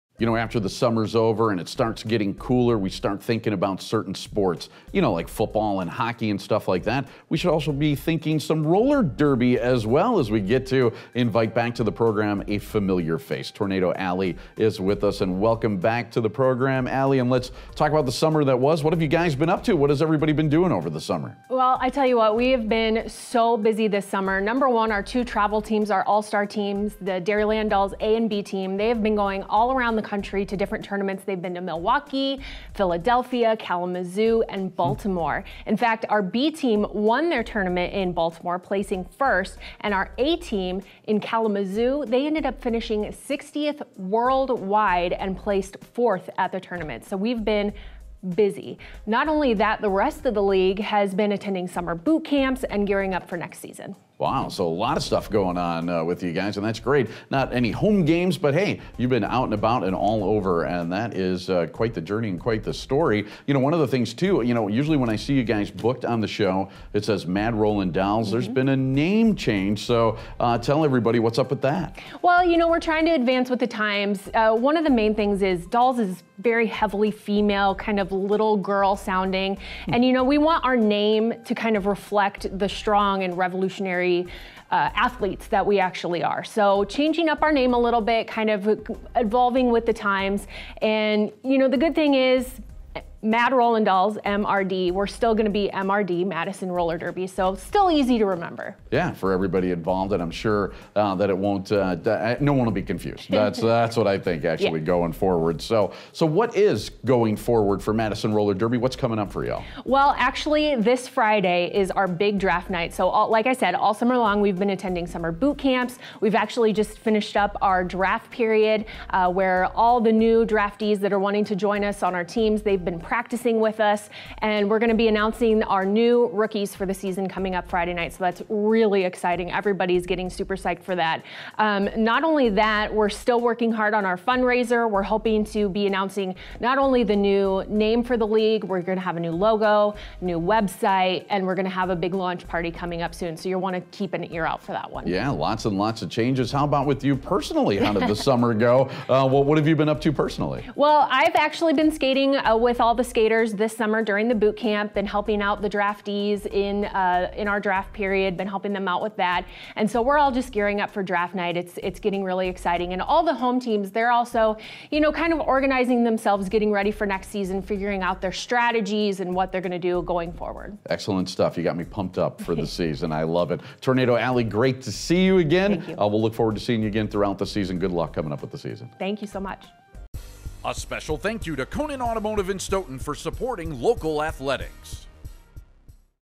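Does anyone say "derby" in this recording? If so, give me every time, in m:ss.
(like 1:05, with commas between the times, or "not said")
0:09, 1:36, 1:48.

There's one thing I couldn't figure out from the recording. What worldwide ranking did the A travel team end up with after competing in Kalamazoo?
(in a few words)
60th.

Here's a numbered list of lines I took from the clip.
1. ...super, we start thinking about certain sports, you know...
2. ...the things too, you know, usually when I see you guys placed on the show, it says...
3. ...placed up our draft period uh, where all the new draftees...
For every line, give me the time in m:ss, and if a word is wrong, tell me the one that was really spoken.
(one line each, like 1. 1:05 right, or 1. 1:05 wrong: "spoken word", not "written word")
1. 0:02 wrong: "cooler", not "super"
2. 1:03 wrong: "booked", not "placed"
3. 1:56 wrong: "finished", not "placed".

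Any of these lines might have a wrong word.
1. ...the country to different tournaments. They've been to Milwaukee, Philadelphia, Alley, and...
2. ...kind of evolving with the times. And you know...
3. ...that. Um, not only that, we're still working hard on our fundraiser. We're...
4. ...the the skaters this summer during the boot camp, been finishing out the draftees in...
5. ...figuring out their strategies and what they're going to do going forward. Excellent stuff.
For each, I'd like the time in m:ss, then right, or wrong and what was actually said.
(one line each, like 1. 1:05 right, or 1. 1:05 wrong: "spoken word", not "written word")
1. 0:29 wrong: "Kalamazoo", not "Alley"
2. 1:28 right
3. 2:10 right
4. 2:32 wrong: "helping", not "finishing"
5. 2:47 right.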